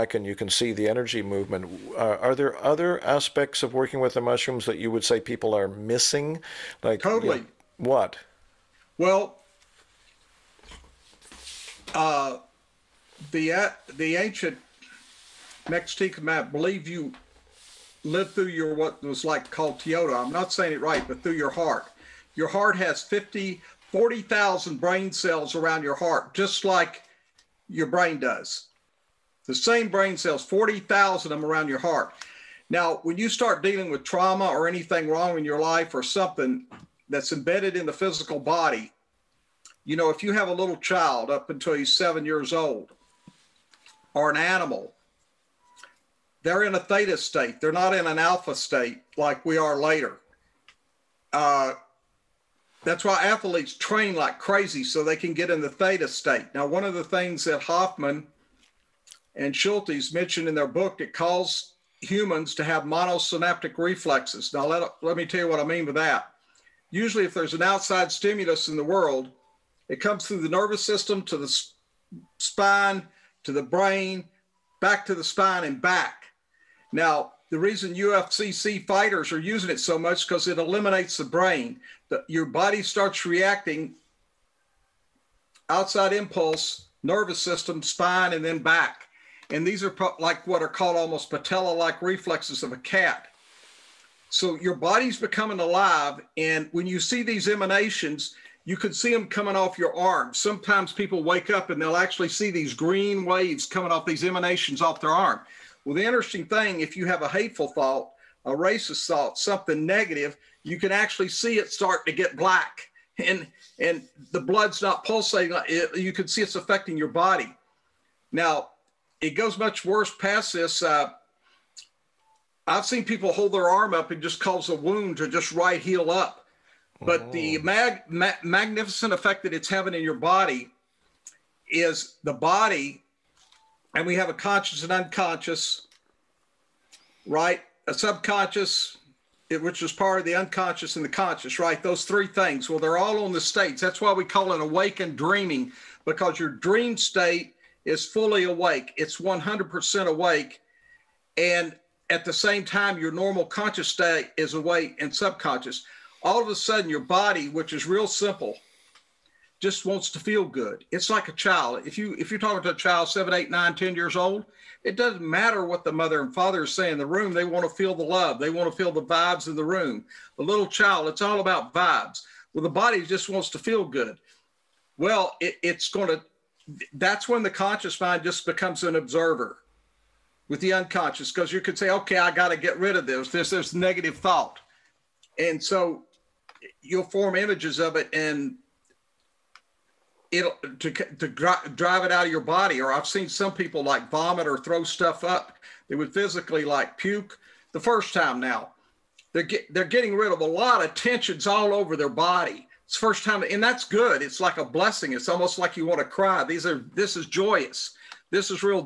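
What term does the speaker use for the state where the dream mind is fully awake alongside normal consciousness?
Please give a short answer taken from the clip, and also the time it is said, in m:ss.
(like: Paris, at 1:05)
awakened dreaming, at 2:24.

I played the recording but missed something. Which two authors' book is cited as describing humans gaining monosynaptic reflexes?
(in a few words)
Hofmann and Schultes.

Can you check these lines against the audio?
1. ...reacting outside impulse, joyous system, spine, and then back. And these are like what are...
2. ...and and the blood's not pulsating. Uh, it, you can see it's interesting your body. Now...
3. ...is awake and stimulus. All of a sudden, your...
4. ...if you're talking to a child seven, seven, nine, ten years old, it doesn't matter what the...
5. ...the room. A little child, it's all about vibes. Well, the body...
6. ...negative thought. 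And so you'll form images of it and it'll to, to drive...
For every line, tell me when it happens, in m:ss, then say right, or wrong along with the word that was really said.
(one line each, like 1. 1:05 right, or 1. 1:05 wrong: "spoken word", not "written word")
1. 1:23 wrong: "nervous", not "joyous"
2. 1:53 wrong: "affecting", not "interesting"
3. 2:34 wrong: "subconscious", not "stimulus"
4. 2:42 wrong: "eight", not "seven"
5. 2:49 right
6. 3:03 right.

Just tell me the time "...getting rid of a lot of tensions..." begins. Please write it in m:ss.
3:19.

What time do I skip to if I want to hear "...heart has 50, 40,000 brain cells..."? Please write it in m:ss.
0:22.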